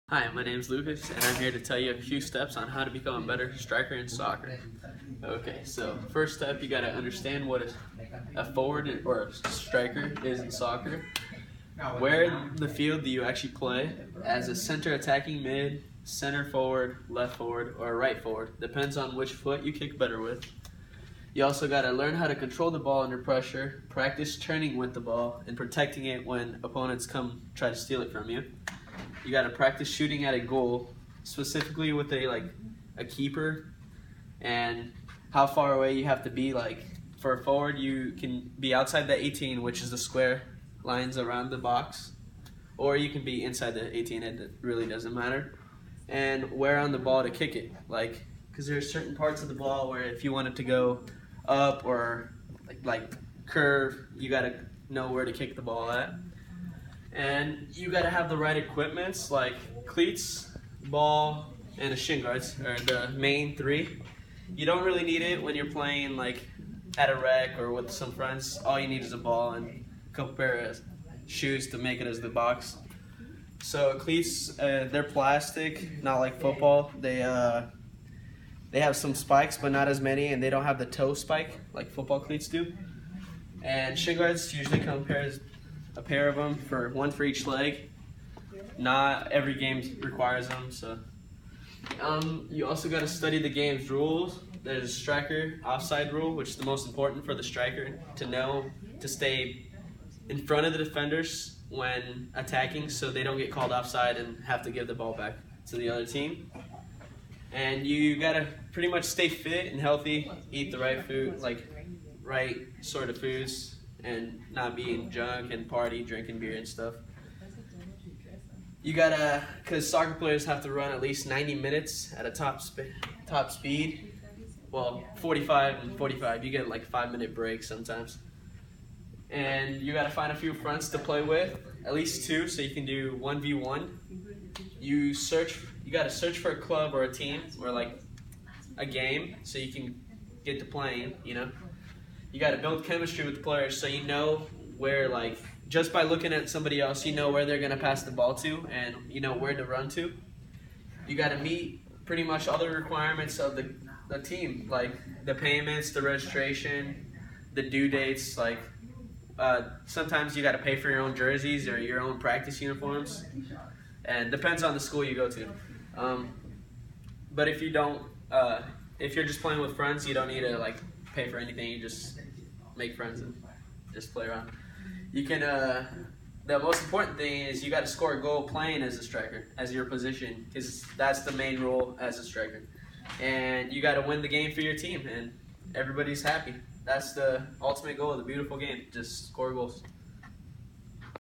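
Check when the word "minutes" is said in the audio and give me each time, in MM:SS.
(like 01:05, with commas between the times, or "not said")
02:01, 02:07.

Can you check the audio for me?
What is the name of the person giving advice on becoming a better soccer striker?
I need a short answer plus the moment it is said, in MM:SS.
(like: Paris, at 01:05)
Lucas, at 00:00.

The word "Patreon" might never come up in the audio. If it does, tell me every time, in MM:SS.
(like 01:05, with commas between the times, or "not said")
not said.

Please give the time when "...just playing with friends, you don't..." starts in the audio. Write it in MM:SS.
02:49.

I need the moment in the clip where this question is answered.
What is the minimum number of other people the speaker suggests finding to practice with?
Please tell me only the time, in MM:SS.
02:12.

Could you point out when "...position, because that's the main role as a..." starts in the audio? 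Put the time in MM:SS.
02:59.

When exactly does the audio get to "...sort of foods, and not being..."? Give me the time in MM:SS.
01:52.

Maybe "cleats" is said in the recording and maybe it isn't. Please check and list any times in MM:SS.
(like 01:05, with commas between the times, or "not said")
00:59, 01:13, 01:22.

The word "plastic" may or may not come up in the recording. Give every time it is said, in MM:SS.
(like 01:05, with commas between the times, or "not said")
01:15.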